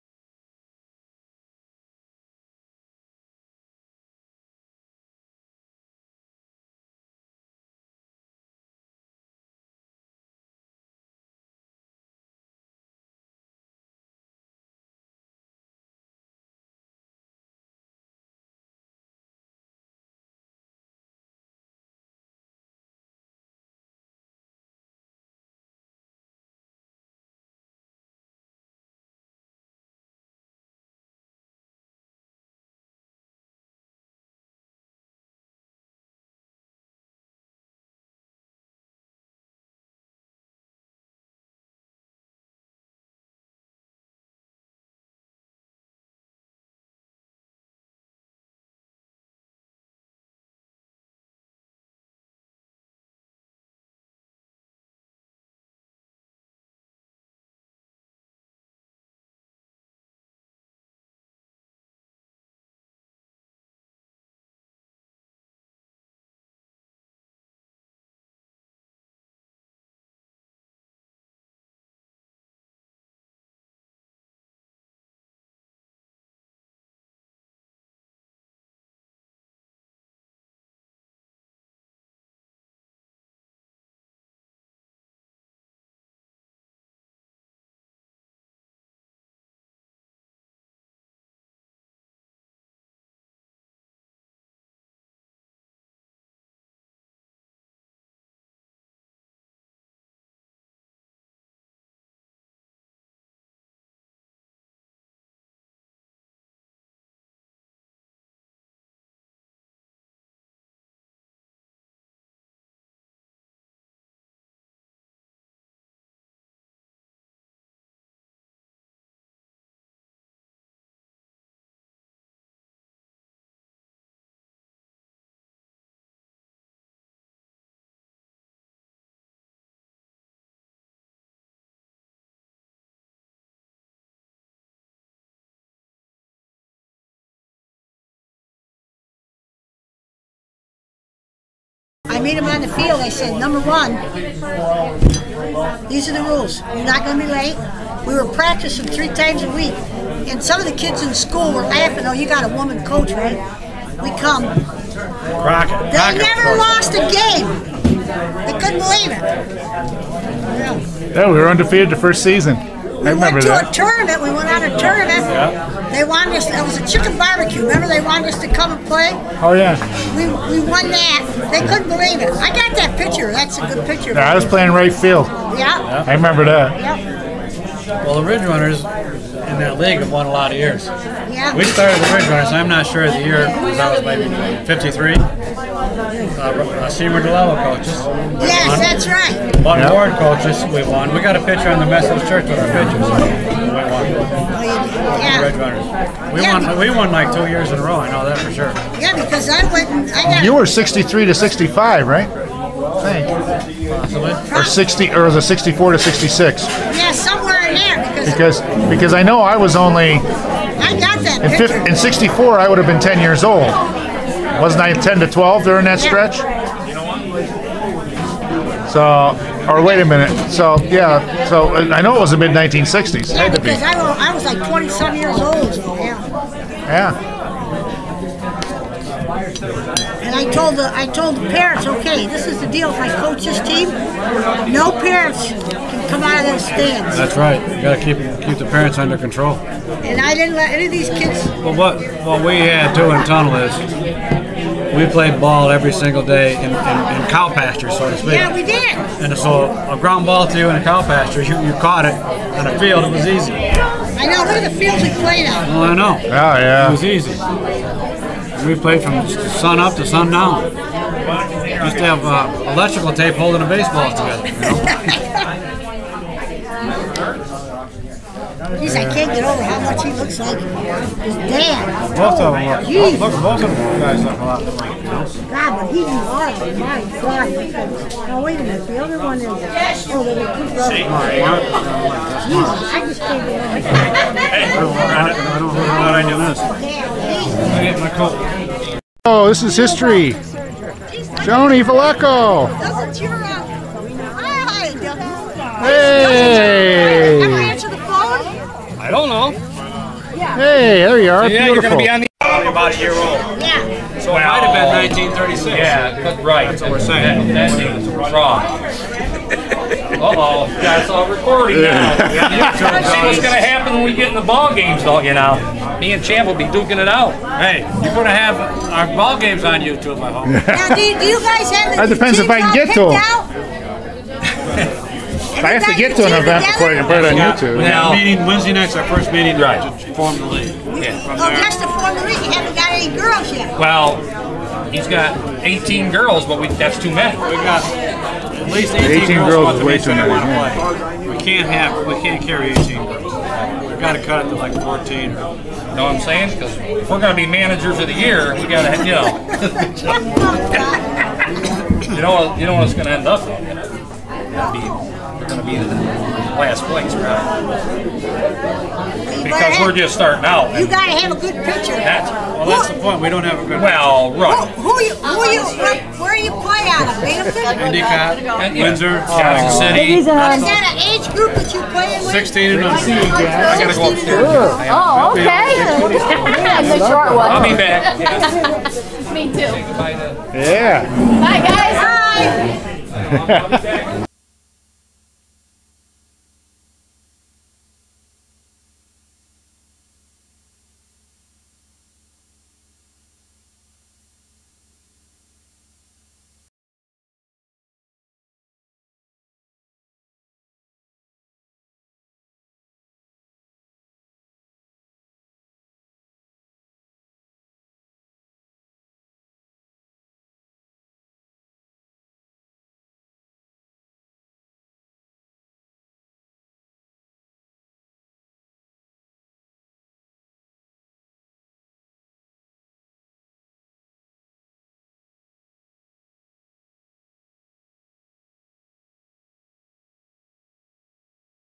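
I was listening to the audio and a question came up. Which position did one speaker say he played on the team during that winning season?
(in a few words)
Right field.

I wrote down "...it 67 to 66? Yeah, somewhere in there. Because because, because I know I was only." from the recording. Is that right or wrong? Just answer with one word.
wrong.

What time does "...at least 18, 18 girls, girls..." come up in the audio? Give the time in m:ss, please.
5:37.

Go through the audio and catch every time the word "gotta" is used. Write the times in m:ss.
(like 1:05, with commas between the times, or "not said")
6:13.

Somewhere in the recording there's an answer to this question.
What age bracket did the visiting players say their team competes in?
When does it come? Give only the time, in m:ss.
6:12.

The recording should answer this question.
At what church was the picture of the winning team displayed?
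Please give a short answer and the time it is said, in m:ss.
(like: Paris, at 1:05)
Methodist Church, at 3:11.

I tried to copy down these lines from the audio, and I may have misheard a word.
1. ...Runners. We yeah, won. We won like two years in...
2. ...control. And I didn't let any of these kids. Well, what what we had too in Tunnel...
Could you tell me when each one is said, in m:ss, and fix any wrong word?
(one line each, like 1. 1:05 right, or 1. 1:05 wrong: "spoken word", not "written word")
1. 3:15 right
2. 3:59 right.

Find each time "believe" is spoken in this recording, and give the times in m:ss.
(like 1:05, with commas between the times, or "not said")
2:38, 2:51.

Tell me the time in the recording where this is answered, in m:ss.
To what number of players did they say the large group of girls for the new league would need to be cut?
5:44.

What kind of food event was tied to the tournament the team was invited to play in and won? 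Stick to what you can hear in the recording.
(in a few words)
Chicken barbecue.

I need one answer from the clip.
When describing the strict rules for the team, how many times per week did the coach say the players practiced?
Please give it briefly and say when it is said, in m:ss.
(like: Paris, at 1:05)
3, at 2:28.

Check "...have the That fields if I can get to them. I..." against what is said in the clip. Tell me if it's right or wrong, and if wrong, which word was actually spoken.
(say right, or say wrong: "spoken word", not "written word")
wrong: "depends", not "fields".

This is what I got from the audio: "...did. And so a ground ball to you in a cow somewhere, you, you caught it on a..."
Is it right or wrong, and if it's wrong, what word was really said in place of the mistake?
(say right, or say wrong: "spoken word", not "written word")
wrong: "pasture", not "somewhere".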